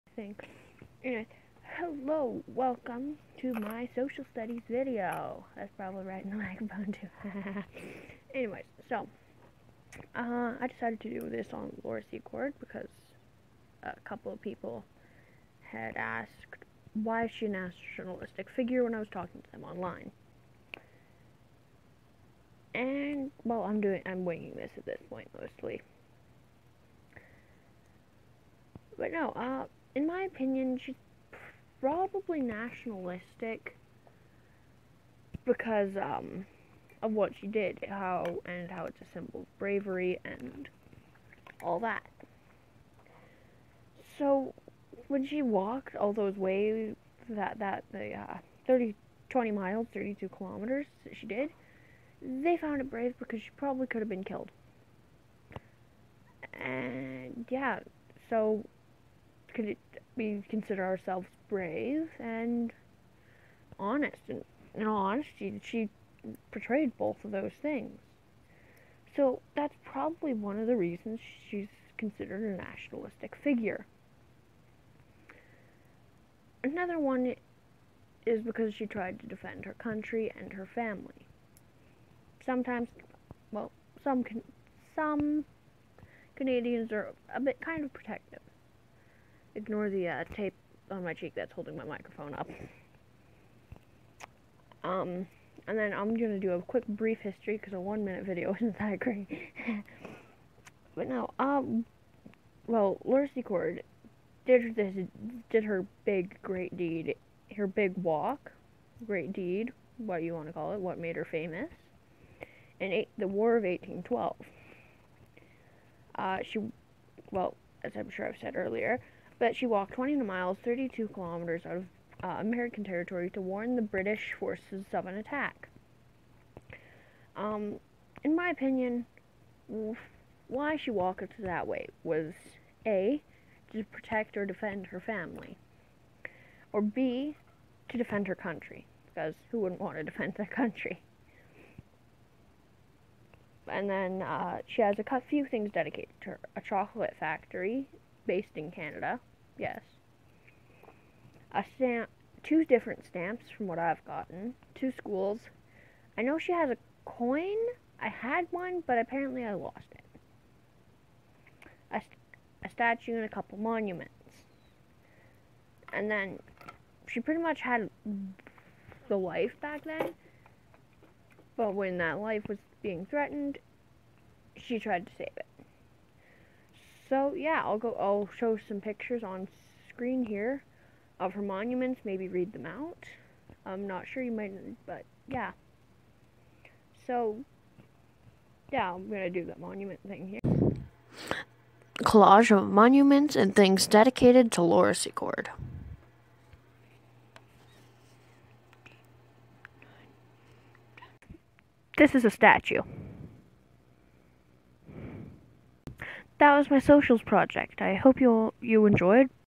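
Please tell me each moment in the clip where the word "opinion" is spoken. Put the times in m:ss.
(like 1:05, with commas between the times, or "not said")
0:30, 2:08.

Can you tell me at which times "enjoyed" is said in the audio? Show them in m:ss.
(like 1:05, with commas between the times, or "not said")
3:28.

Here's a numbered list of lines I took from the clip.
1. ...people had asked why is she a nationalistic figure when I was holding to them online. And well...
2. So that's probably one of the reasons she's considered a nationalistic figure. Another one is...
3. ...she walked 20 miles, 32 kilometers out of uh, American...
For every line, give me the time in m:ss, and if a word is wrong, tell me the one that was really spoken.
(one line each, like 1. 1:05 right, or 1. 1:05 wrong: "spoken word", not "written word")
1. 0:14 wrong: "talking", not "holding"
2. 1:09 right
3. 1:59 right.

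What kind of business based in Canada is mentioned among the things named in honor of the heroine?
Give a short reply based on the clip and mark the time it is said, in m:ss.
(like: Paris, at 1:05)
chocolate factory, at 2:26.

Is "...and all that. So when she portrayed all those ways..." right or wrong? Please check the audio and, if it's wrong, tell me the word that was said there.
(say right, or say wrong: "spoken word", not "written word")
wrong: "walked", not "portrayed".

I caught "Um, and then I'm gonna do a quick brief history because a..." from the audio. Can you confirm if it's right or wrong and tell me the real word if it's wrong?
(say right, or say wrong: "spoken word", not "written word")
right.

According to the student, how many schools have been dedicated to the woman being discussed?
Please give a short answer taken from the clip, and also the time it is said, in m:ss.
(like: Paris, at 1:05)
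2, at 2:34.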